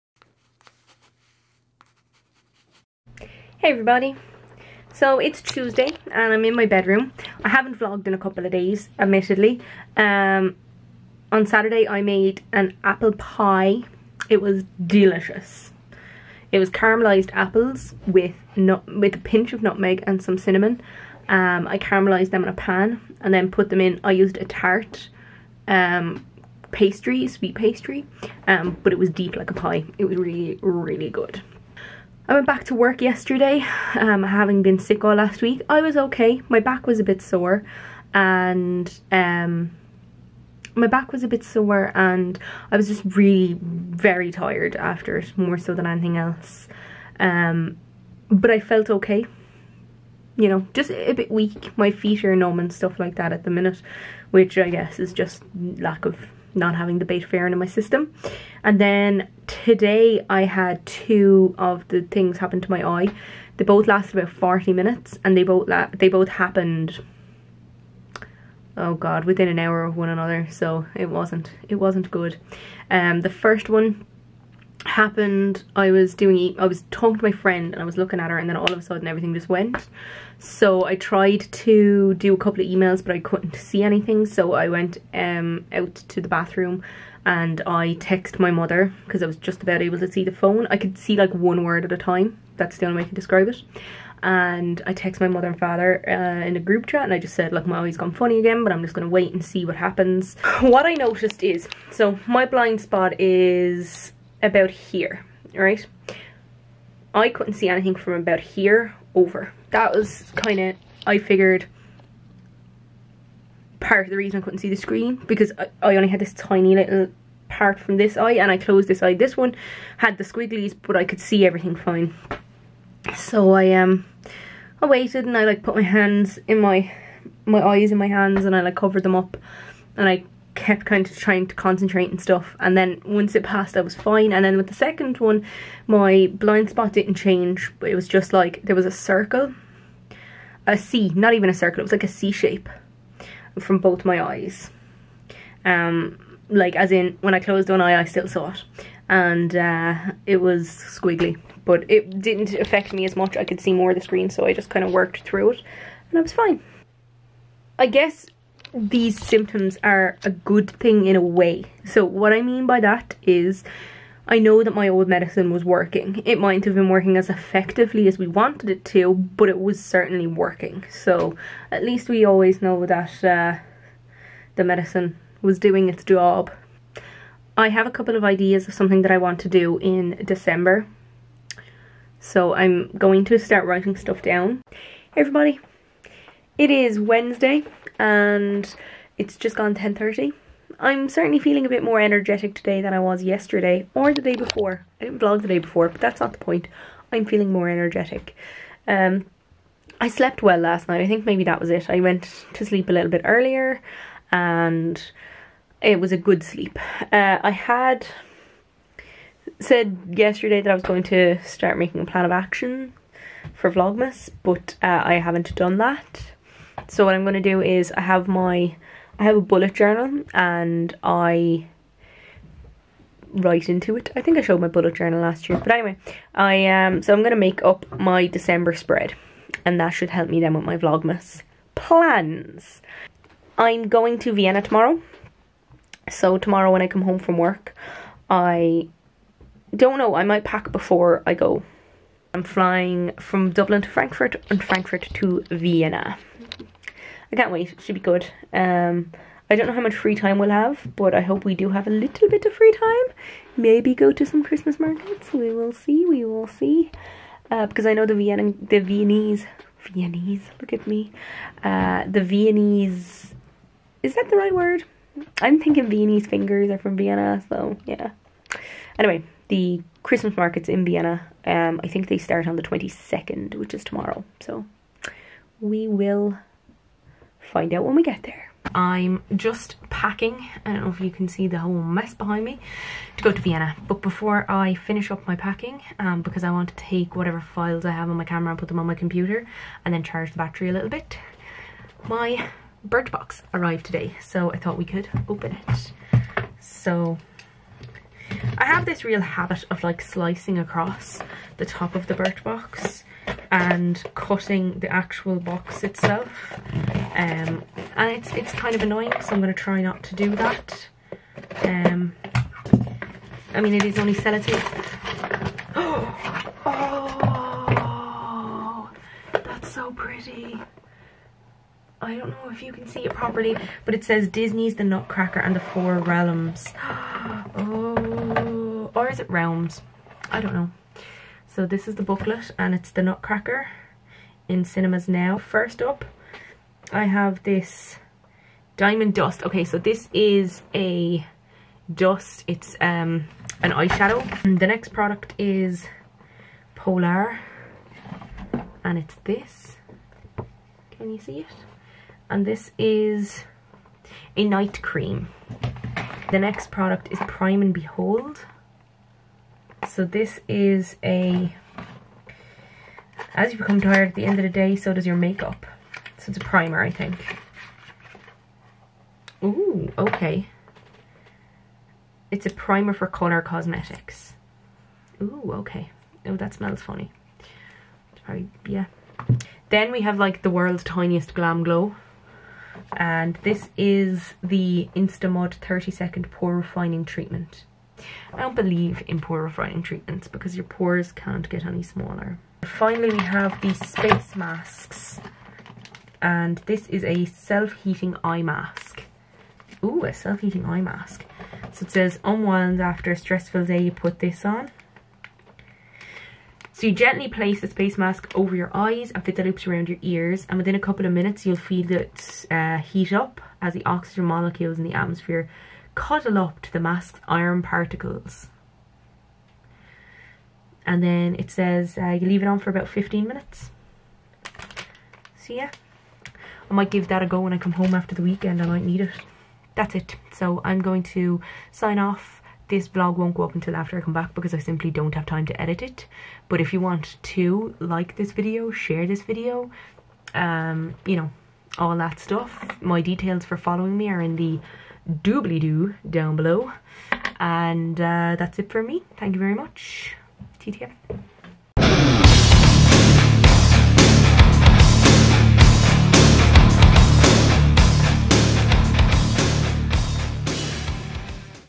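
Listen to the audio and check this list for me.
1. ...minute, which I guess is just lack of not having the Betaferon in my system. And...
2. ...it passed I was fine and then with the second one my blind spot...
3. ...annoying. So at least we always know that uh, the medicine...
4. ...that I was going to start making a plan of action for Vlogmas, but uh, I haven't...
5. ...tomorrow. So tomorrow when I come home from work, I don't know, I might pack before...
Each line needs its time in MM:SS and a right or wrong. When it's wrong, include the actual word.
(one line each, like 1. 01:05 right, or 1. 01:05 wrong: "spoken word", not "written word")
1. 00:53 right
2. 02:13 right
3. 02:50 wrong: "working", not "annoying"
4. 03:30 right
5. 03:54 right.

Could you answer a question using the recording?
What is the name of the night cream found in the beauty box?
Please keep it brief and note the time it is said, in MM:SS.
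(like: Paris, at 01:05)
Polar, at 05:46.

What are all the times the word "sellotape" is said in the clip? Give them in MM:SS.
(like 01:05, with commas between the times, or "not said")
05:14.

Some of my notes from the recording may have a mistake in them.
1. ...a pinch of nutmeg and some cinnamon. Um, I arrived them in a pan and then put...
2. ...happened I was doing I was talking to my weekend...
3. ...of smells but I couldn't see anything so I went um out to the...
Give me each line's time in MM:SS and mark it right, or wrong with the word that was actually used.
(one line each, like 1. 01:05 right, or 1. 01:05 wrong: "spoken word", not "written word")
1. 00:19 wrong: "caramelized", not "arrived"
2. 01:14 wrong: "friend", not "weekend"
3. 01:22 wrong: "emails", not "smells".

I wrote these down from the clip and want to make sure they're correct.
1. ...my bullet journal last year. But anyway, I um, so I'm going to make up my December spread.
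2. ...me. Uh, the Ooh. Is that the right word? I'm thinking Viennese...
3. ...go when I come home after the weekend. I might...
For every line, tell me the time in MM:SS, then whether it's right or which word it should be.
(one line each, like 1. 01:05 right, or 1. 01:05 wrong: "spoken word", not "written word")
1. 03:44 right
2. 04:20 wrong: "Viennese", not "Ooh"
3. 07:07 right.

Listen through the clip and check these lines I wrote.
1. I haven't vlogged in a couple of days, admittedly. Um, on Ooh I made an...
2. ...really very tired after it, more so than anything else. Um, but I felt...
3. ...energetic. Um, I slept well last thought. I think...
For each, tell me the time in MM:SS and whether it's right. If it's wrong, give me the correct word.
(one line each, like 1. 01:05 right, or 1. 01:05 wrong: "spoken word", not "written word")
1. 00:07 wrong: "Saturday", not "Ooh"
2. 00:43 right
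3. 03:17 wrong: "night", not "thought".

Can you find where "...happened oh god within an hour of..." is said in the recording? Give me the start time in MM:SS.
01:06.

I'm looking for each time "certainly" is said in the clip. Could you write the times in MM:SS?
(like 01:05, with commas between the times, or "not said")
02:49, 03:11.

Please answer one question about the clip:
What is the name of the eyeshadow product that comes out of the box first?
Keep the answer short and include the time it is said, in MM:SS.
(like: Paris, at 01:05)
Diamond Dust, at 05:38.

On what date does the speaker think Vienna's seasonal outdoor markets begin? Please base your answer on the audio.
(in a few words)
22nd.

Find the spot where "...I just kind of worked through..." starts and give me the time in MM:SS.
02:34.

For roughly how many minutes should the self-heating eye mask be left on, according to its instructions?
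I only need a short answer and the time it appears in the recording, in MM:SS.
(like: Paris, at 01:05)
15, at 07:02.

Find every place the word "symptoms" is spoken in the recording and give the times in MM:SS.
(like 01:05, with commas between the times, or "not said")
02:39.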